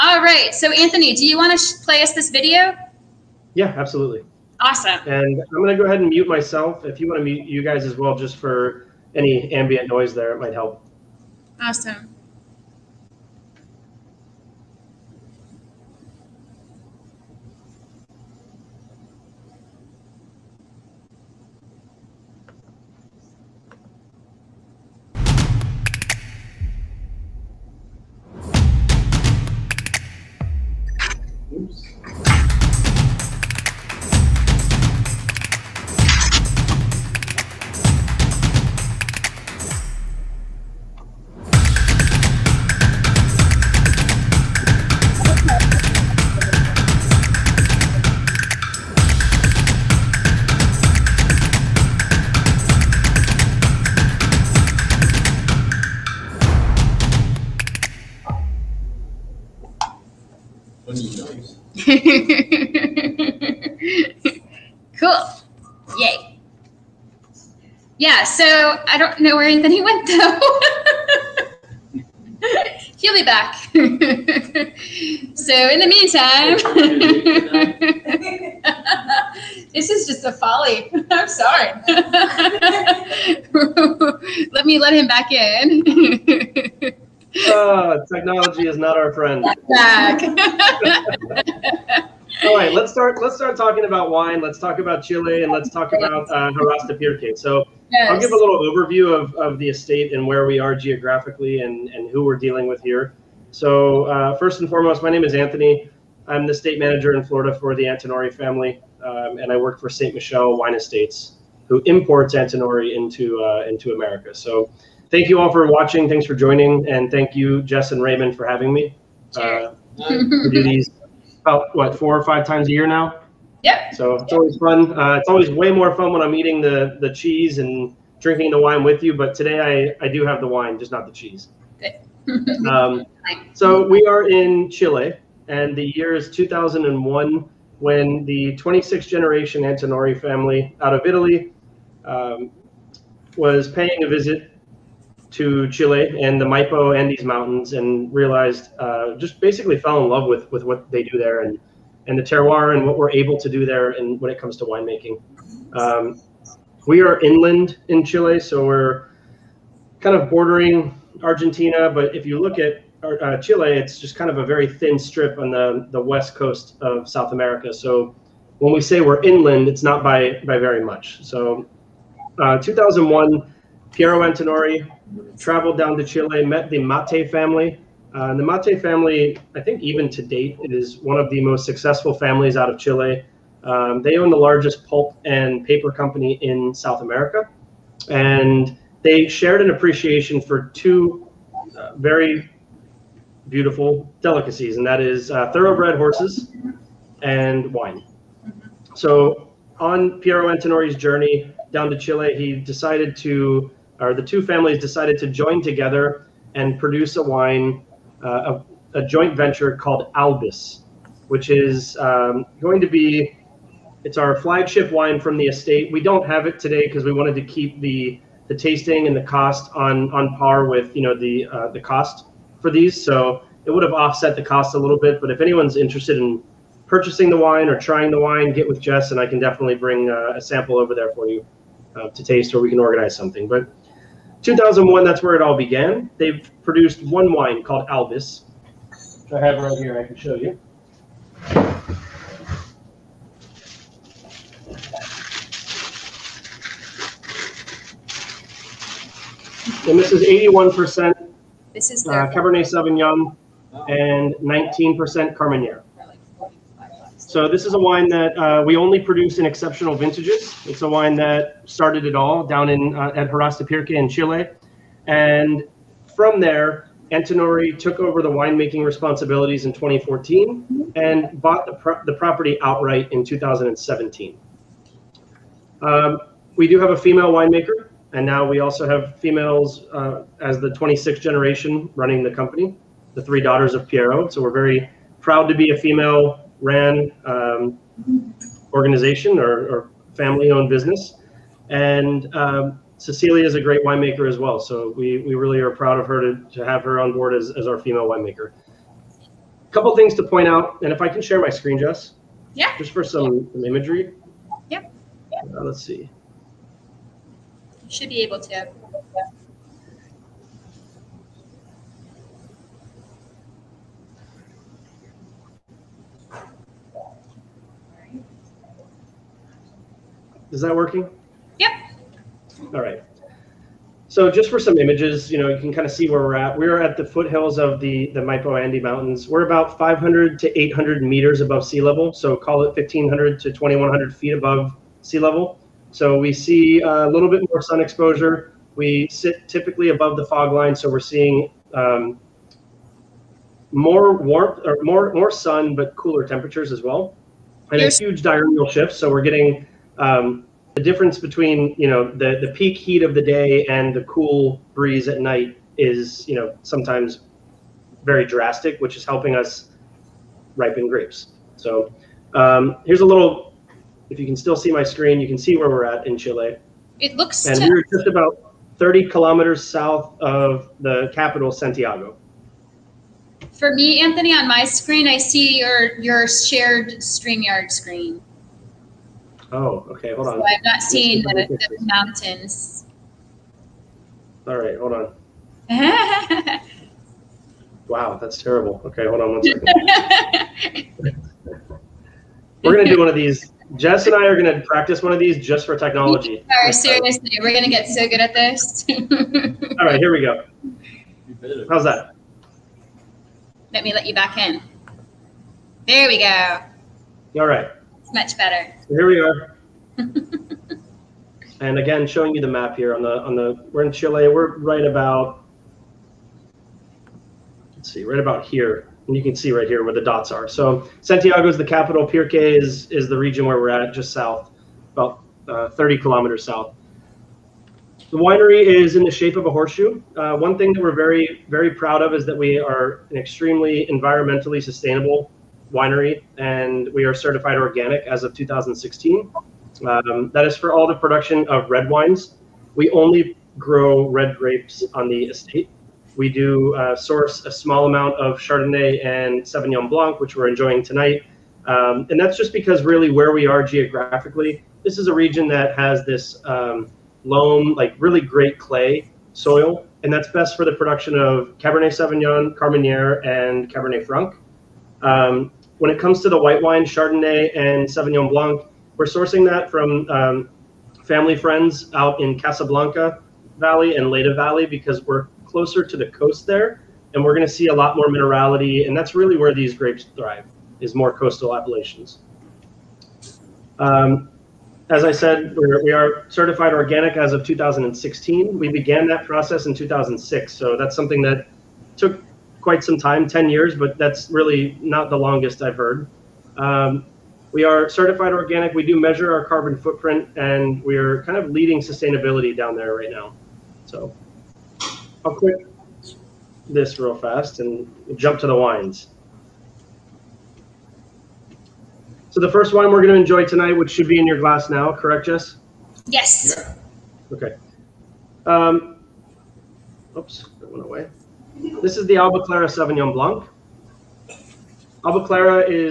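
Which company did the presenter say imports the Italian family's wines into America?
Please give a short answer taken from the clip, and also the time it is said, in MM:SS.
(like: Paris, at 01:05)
St. Michelle Wine Estates, at 01:49.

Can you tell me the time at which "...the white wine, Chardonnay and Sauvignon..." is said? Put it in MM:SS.
07:46.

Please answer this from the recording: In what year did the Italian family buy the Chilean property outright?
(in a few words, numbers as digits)
2017.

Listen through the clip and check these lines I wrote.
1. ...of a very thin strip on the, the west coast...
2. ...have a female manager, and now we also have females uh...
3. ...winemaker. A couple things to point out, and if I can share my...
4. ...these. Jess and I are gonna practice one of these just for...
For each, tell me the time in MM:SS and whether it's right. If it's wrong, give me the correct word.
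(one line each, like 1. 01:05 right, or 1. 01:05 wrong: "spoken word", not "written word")
1. 02:44 right
2. 04:36 wrong: "winemaker", not "manager"
3. 04:58 right
4. 06:33 right.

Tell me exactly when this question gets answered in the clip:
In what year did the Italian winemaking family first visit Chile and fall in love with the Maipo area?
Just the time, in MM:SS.
02:15.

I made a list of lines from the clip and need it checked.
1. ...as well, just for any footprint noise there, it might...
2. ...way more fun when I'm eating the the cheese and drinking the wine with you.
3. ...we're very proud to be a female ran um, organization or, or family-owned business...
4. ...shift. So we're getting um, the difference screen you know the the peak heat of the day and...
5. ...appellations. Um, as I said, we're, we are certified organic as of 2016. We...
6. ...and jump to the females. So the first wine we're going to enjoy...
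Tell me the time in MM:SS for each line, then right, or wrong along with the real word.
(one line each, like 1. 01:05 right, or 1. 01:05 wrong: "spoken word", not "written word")
1. 00:07 wrong: "ambient", not "footprint"
2. 02:05 right
3. 04:44 right
4. 05:48 wrong: "between", not "screen"
5. 08:01 right
6. 08:27 wrong: "wines", not "females".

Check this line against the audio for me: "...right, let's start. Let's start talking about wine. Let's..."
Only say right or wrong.
right.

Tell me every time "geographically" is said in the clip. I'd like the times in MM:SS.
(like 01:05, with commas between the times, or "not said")
01:40, 07:33.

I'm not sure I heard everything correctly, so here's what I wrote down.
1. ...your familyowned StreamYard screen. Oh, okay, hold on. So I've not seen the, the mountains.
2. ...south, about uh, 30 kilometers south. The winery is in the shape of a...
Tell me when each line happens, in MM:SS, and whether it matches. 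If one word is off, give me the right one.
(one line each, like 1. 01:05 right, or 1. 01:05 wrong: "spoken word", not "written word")
1. 06:15 wrong: "shared", not "familyowned"
2. 07:04 right.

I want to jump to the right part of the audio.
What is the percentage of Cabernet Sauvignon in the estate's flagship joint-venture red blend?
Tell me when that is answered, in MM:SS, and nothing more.
04:10.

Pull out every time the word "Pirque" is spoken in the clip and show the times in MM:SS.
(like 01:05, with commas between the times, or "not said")
01:36, 04:23, 07:02.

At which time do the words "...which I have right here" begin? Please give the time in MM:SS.
03:59.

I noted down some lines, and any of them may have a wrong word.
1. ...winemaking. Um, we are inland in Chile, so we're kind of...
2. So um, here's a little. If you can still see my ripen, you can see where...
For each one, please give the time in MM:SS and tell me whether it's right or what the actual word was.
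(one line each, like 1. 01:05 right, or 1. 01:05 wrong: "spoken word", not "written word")
1. 02:34 right
2. 06:01 wrong: "screen", not "ripen".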